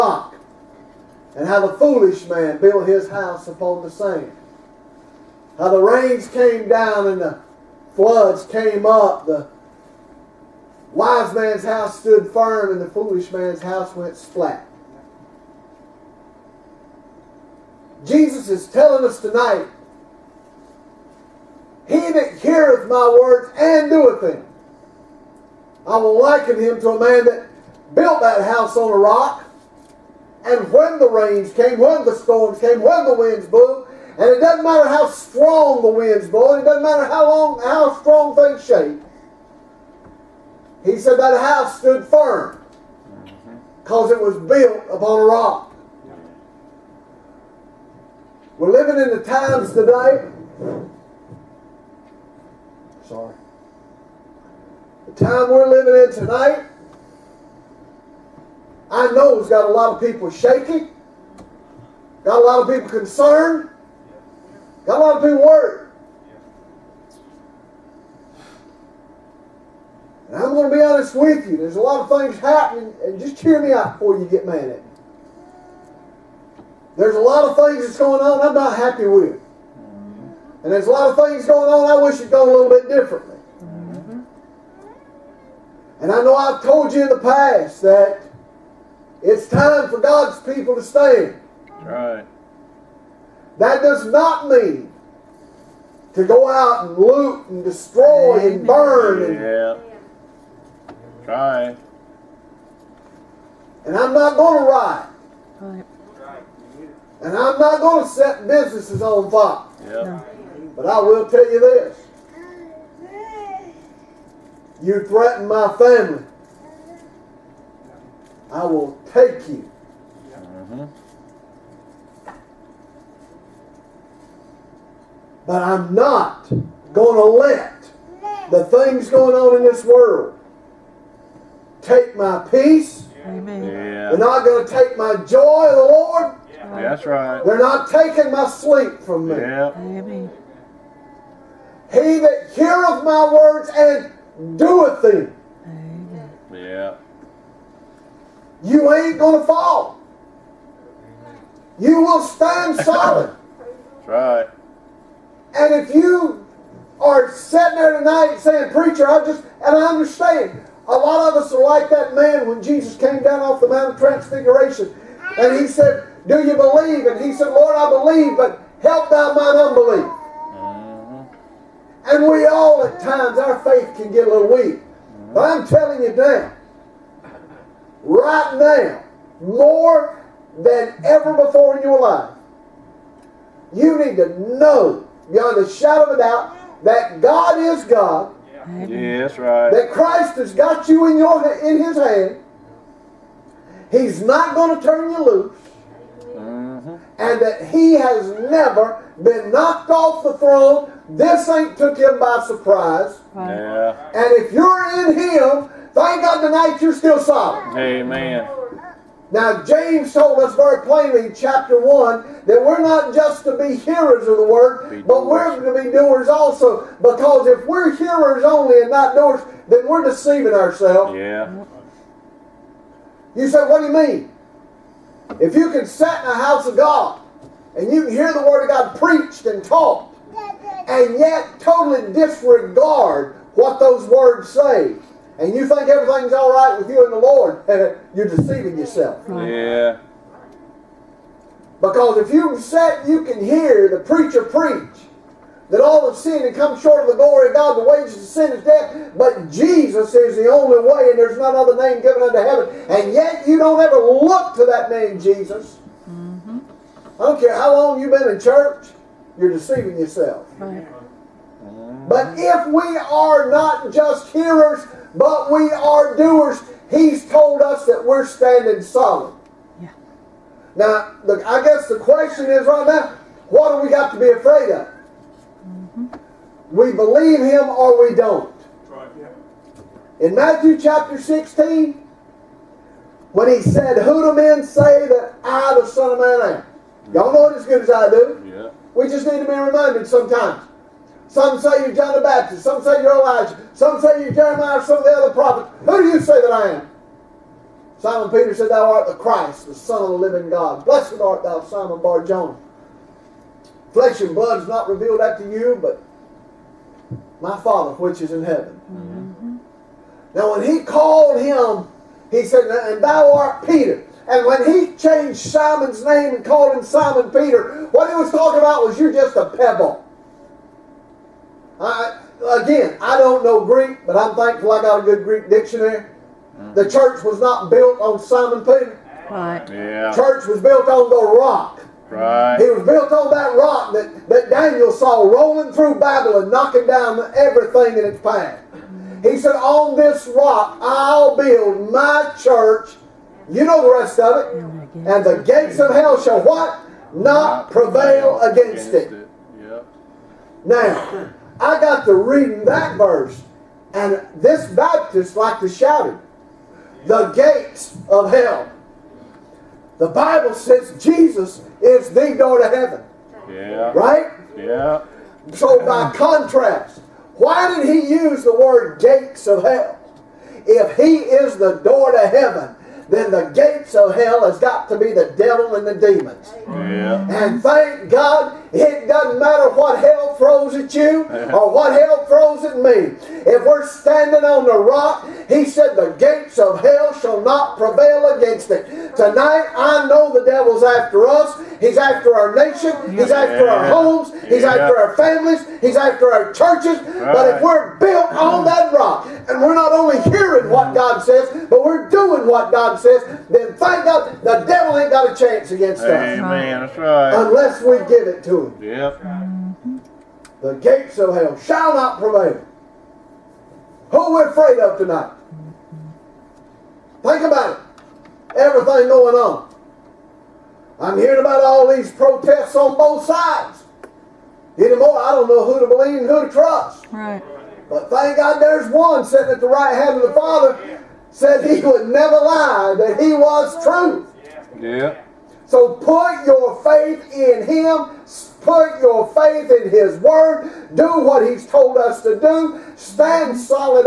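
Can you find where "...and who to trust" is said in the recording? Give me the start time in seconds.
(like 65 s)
426 s.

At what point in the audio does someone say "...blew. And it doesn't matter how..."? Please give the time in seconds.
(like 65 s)
33 s.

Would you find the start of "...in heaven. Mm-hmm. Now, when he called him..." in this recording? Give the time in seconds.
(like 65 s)
308 s.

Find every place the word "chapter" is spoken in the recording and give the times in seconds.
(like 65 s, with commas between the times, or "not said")
211 s, 280 s.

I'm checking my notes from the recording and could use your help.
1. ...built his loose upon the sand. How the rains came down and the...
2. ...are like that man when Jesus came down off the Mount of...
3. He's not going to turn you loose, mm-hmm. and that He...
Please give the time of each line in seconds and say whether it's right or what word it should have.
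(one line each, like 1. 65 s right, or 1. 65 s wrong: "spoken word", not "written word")
1. 2 s wrong: "house", not "loose"
2. 161 s right
3. 193 s right.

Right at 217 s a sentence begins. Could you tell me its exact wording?
Because if we're hearers only and not doers, then we're deceiving ourselves.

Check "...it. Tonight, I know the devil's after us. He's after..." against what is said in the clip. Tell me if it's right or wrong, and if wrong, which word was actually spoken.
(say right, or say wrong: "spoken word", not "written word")
right.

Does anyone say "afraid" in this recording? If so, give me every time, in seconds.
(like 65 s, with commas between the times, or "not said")
274 s, 414 s.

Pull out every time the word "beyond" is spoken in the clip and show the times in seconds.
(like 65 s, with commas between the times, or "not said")
185 s.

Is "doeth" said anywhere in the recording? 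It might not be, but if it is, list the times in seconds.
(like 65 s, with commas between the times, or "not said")
23 s, 144 s.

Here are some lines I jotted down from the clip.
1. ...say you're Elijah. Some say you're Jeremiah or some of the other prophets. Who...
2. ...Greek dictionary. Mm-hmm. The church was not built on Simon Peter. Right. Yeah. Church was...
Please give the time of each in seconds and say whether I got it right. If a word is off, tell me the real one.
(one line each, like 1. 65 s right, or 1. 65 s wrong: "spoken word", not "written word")
1. 292 s right
2. 325 s right.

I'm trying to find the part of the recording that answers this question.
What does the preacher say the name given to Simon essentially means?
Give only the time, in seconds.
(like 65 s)
319 s.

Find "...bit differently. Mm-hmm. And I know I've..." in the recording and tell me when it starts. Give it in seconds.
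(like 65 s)
82 s.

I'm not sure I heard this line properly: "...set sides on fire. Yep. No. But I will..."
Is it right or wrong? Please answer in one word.
wrong.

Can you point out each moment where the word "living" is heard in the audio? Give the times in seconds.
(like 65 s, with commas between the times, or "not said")
48 s, 55 s, 300 s.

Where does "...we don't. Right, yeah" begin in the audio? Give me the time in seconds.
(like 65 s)
278 s.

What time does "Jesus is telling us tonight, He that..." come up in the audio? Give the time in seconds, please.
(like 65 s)
18 s.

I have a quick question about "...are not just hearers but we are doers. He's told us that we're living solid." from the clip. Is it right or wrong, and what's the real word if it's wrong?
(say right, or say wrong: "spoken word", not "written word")
wrong: "standing", not "living".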